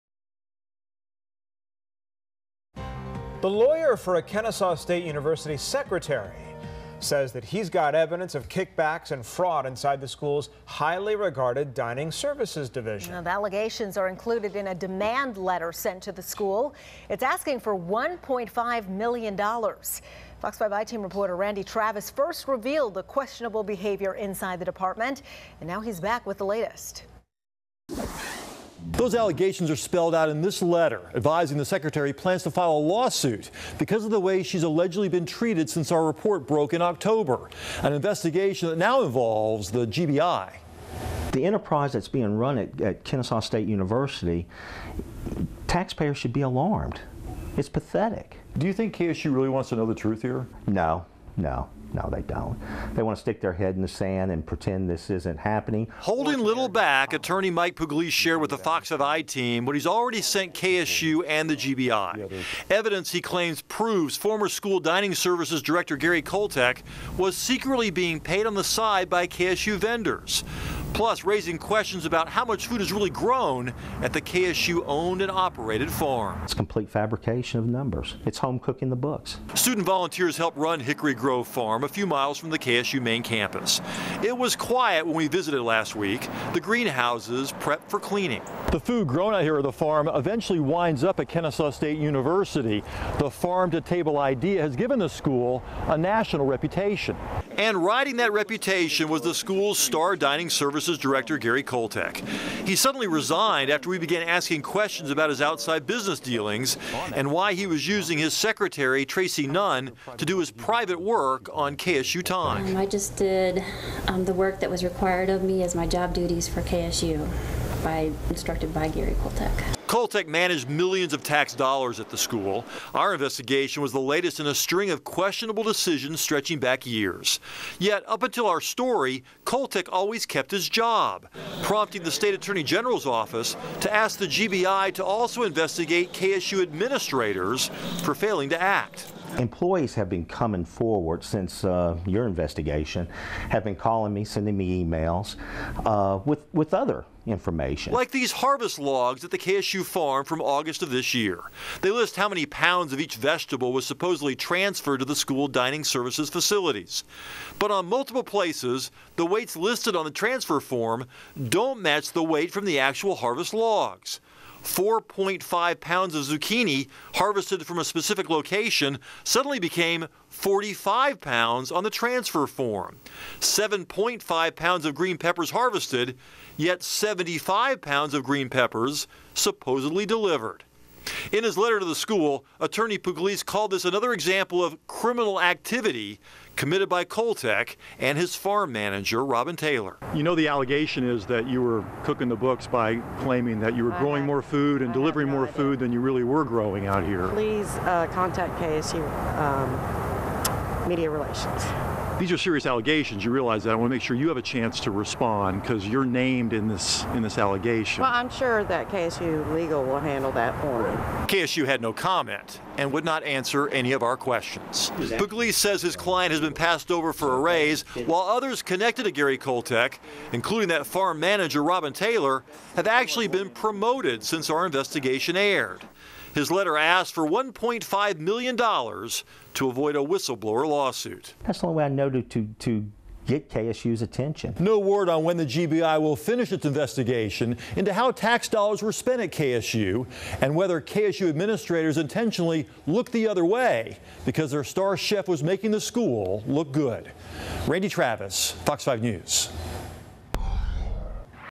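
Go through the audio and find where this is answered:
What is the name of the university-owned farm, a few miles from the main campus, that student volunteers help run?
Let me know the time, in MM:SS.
01:20.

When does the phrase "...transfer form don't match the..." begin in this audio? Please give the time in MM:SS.
02:40.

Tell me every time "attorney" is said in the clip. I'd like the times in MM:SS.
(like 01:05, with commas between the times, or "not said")
00:57, 02:12, 03:02.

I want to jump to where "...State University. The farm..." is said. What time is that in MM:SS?
01:31.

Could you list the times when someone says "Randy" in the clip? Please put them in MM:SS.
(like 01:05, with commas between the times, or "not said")
00:21, 04:07.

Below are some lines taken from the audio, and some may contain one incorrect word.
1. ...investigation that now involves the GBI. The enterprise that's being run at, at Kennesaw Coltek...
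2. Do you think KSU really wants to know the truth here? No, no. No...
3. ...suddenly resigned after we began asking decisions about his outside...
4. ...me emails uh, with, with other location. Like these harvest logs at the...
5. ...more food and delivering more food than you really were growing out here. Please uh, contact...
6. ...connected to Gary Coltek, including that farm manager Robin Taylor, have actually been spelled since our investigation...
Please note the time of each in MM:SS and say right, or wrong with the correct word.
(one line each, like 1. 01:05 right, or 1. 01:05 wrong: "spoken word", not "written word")
1. 00:37 wrong: "State", not "Coltek"
2. 00:48 right
3. 01:42 wrong: "questions", not "decisions"
4. 02:24 wrong: "information", not "location"
5. 03:14 right
6. 03:38 wrong: "promoted", not "spelled".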